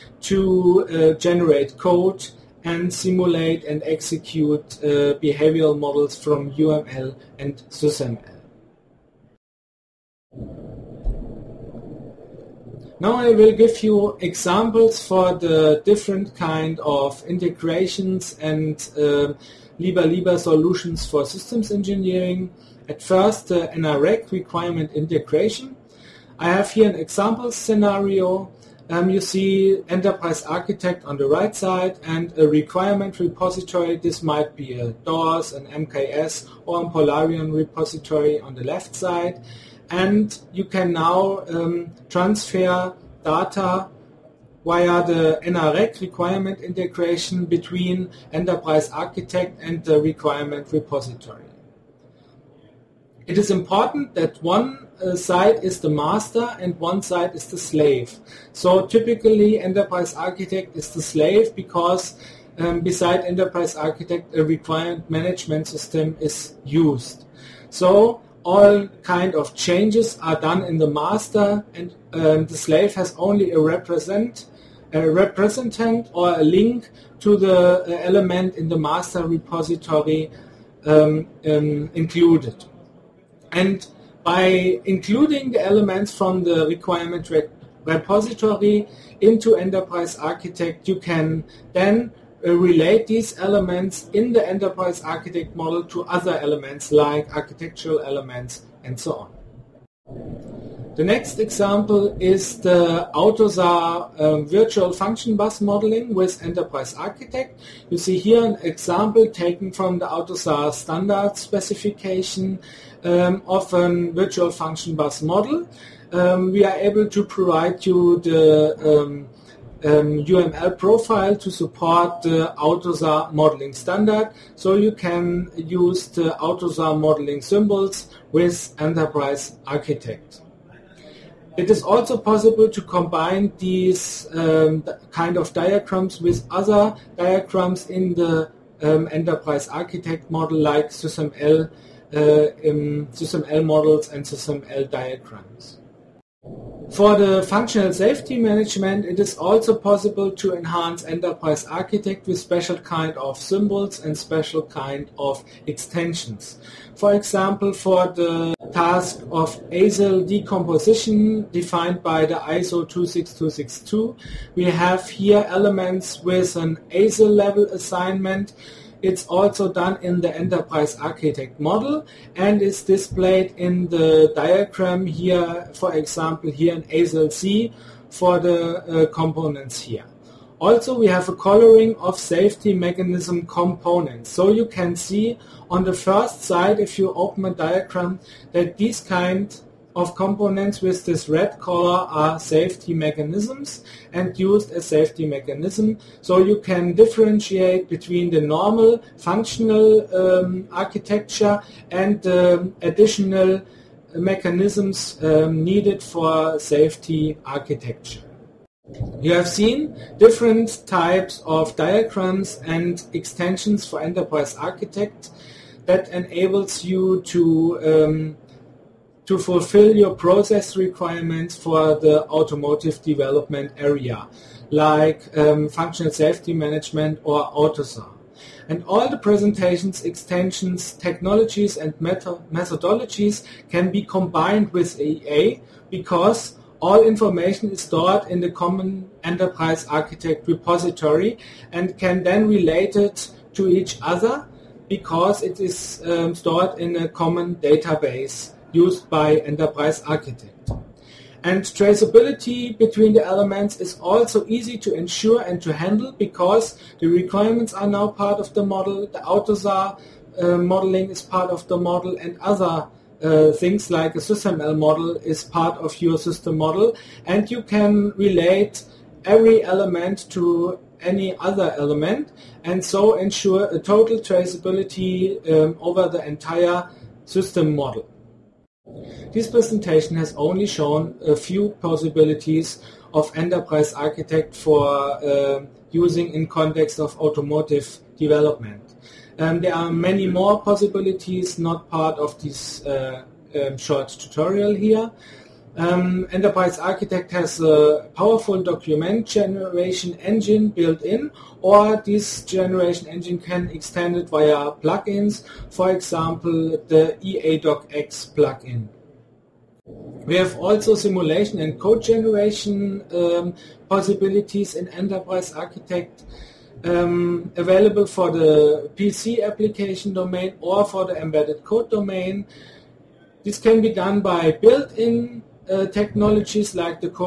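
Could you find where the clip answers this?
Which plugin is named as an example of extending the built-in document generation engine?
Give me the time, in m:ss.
5:07.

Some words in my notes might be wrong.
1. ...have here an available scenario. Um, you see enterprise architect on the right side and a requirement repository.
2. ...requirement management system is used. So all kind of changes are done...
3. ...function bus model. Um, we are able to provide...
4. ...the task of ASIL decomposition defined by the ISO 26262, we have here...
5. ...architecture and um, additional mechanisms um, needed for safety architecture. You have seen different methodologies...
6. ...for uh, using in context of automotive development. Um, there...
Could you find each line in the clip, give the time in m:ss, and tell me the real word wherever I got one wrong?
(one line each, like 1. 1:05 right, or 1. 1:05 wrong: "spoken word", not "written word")
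1. 0:26 wrong: "example", not "available"
2. 1:04 right
3. 1:54 right
4. 2:38 right
5. 3:20 wrong: "types", not "methodologies"
6. 4:44 right.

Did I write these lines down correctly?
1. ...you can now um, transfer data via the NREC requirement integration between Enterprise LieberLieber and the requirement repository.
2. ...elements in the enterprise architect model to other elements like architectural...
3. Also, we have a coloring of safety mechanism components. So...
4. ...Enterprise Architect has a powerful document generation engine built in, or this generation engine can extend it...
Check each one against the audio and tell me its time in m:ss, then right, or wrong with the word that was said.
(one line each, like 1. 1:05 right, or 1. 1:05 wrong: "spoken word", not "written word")
1. 0:40 wrong: "Architect", not "LieberLieber"
2. 1:33 right
3. 3:00 right
4. 4:56 right.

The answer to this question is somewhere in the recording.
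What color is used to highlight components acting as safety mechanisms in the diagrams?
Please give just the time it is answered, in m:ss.
3:11.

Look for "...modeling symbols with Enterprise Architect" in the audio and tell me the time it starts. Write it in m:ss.
2:06.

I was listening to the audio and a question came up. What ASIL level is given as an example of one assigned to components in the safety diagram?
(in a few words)
ASIL C.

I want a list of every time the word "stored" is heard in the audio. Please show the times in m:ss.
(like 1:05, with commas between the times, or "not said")
3:57, 4:06.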